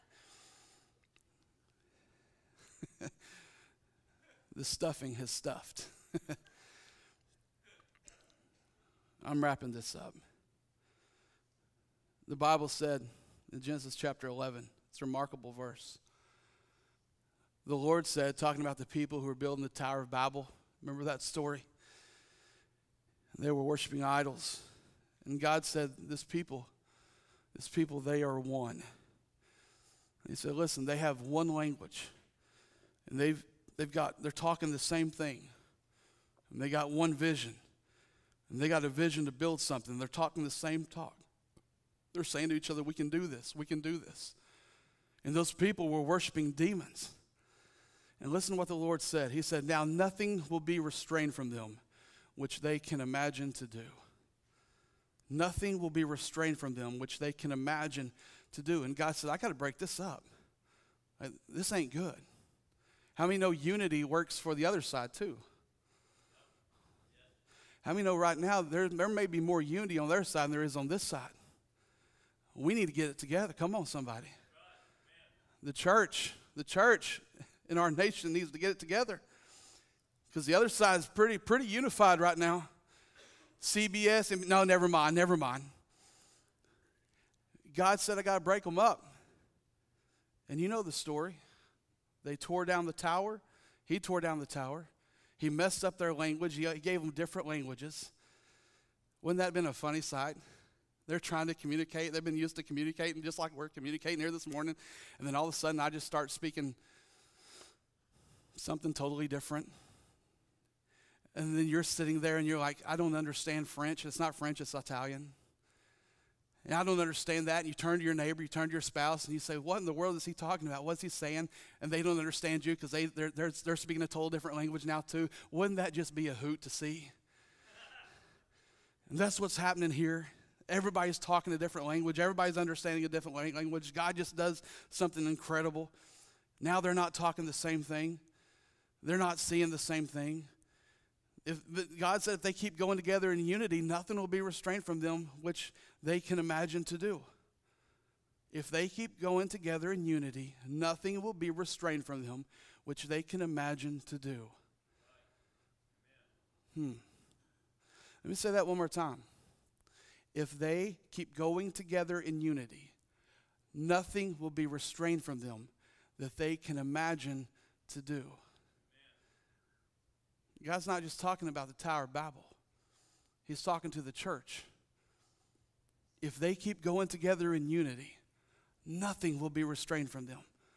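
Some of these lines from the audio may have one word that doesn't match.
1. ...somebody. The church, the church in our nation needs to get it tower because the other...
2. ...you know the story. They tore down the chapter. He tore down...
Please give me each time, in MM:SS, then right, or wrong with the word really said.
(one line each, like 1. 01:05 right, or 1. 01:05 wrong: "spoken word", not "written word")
1. 01:13 wrong: "together", not "tower"
2. 01:30 wrong: "tower", not "chapter".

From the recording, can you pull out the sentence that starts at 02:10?
Everybody's talking a different language, everybody's understanding a different language.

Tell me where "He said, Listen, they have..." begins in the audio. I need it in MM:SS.
00:30.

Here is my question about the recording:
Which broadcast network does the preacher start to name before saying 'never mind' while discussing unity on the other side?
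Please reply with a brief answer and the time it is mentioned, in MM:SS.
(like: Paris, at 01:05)
CBS, at 01:23.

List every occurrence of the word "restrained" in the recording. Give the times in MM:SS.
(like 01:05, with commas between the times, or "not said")
00:50, 00:56, 02:24, 02:31, 02:44, 02:59.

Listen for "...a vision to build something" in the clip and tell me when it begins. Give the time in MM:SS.
00:38.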